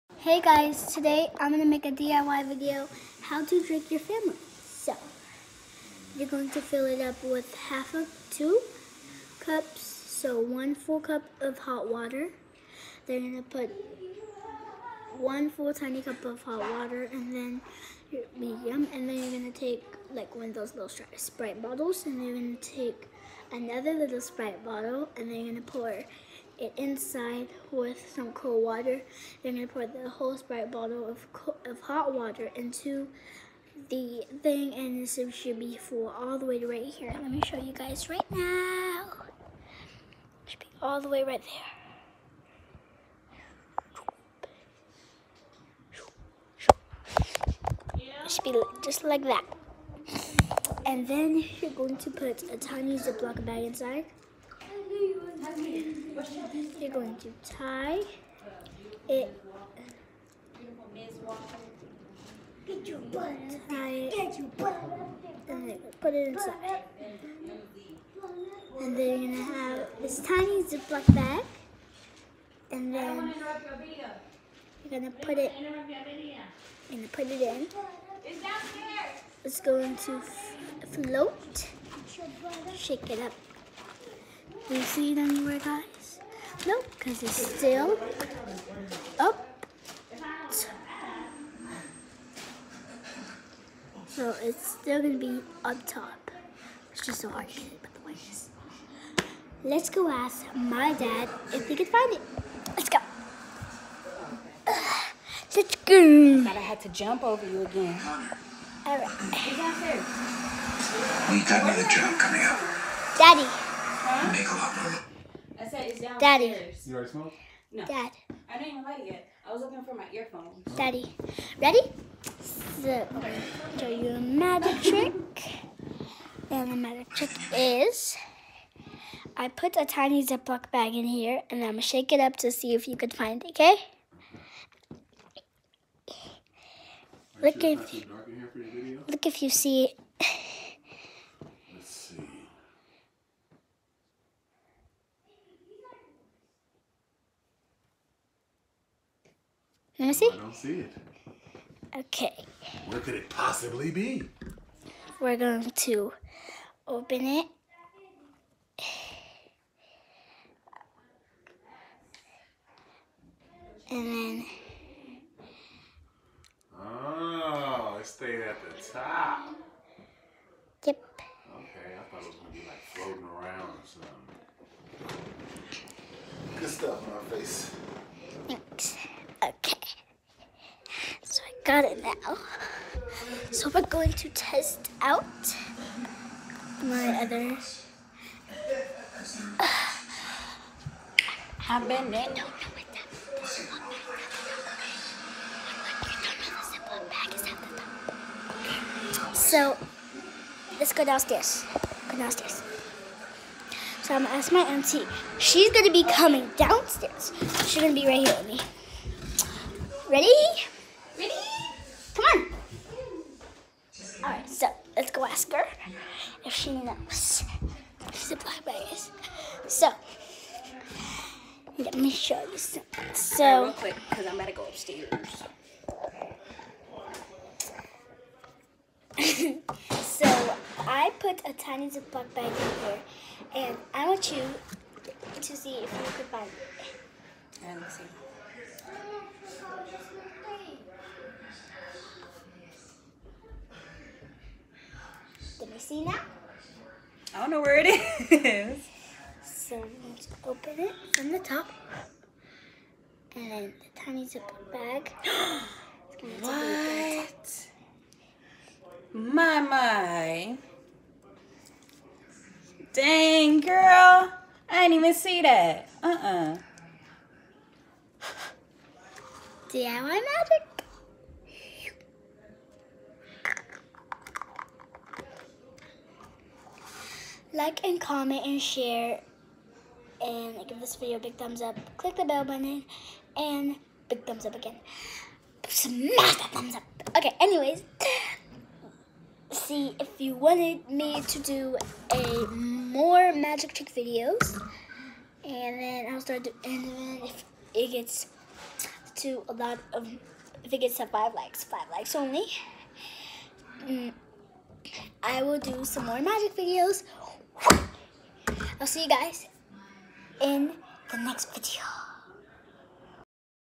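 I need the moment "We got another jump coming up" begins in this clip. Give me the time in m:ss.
1:51.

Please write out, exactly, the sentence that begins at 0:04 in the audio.
So, you're going to fill it up with half of two cups, so one full cup of hot water.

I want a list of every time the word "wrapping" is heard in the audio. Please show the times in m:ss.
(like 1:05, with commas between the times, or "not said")
not said.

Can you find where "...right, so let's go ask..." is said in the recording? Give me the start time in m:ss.
3:34.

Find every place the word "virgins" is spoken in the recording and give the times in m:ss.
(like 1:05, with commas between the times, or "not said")
not said.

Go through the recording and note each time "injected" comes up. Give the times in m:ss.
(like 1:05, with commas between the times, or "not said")
not said.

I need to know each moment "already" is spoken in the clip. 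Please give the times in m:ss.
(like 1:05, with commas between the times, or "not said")
1:56.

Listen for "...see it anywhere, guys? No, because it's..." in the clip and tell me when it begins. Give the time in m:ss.
1:24.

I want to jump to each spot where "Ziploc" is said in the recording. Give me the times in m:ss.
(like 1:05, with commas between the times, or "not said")
0:52, 1:10, 2:10, 3:51.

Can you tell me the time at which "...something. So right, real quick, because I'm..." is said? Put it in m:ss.
3:42.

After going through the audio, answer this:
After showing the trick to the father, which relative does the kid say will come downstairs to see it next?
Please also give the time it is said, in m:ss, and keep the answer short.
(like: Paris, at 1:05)
auntie, at 3:24.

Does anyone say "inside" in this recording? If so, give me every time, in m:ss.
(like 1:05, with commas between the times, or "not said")
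0:26, 0:53, 1:06.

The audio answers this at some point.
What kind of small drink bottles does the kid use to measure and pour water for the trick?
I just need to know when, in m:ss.
0:21.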